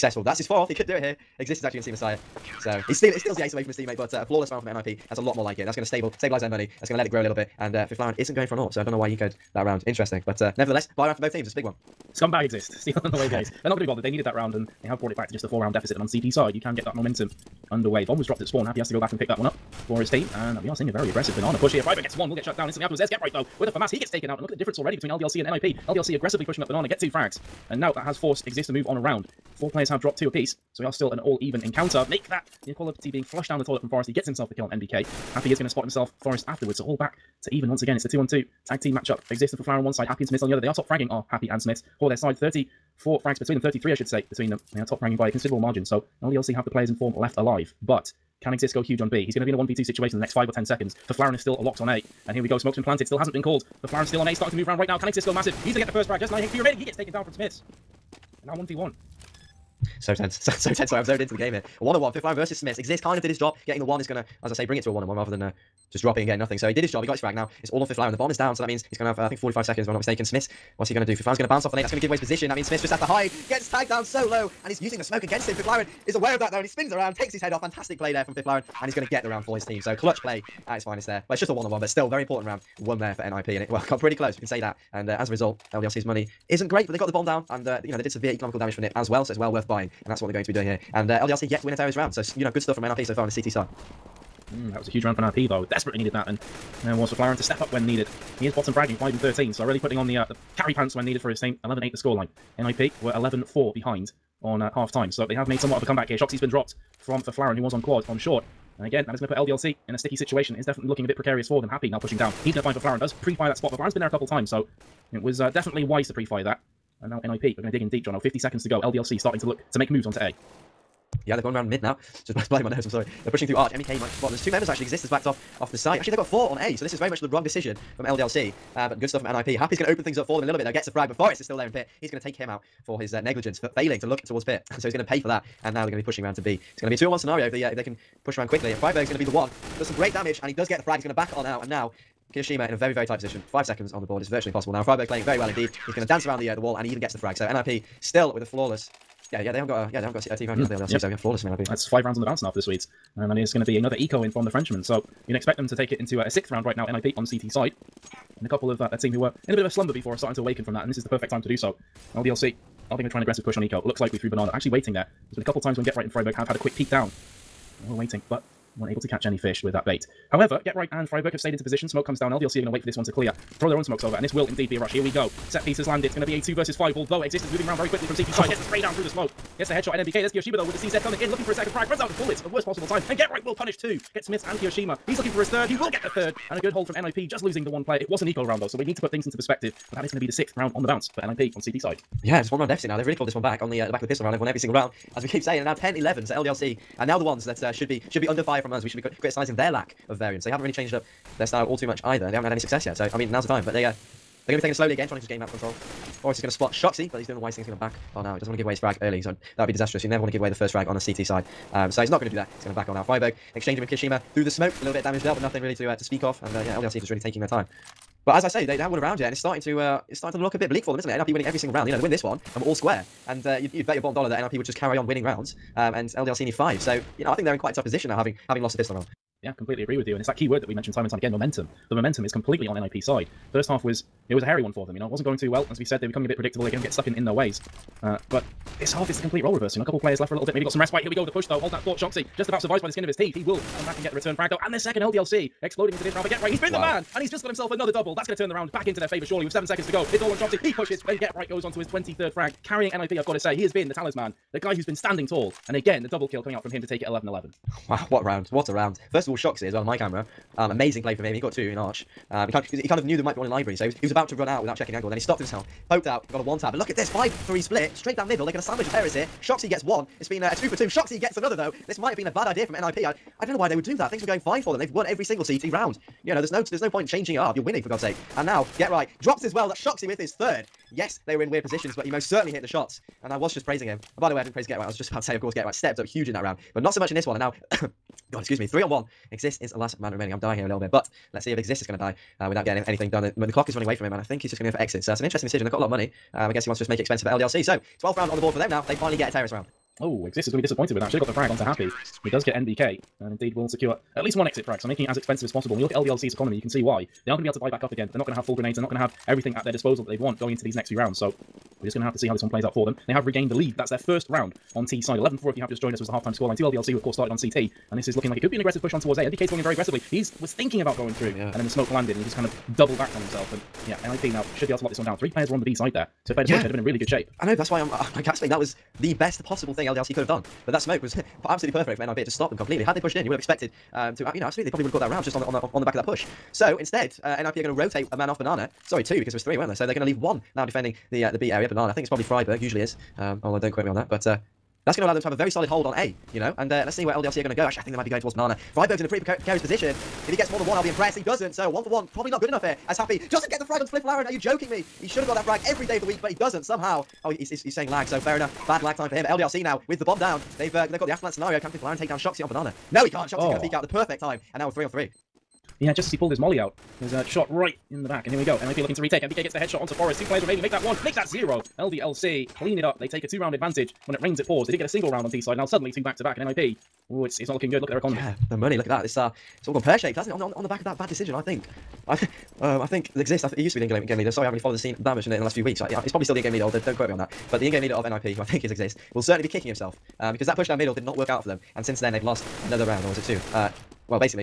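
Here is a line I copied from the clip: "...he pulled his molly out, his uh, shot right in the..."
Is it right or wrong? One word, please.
right.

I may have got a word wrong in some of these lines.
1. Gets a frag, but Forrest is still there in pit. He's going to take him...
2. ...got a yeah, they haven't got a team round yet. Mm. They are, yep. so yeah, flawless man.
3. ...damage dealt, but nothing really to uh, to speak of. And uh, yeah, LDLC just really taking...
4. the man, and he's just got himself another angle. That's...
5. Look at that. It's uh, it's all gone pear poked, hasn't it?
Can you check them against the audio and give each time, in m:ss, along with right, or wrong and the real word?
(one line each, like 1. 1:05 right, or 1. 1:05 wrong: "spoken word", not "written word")
1. 2:10 right
2. 2:29 right
3. 3:35 right
4. 4:06 wrong: "double", not "angle"
5. 6:18 wrong: "shaped", not "poked".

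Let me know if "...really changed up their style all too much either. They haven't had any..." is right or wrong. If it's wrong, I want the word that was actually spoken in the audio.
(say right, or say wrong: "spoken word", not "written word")
right.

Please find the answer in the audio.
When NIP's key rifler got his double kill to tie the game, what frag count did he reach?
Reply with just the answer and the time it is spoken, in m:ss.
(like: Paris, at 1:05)
23, at 4:11.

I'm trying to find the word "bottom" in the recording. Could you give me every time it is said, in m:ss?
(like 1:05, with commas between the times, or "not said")
1:38, 3:43.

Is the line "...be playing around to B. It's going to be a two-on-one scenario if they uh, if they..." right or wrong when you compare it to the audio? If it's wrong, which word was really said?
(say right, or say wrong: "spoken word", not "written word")
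wrong: "pushing", not "playing".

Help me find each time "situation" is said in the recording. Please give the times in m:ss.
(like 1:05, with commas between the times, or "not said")
0:49, 1:50.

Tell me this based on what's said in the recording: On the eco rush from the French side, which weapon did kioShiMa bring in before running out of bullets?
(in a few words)
CZ.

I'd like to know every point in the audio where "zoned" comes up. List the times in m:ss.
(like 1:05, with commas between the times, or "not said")
1:01.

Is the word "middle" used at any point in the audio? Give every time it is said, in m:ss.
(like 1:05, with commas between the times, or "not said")
4:28, 6:30.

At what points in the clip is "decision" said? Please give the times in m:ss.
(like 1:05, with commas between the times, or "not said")
2:07, 4:55, 6:21.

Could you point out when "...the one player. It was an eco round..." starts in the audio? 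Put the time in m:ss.
3:07.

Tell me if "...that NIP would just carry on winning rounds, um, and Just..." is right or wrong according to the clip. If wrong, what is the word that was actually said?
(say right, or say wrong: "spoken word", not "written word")
wrong: "LDLC", not "Just".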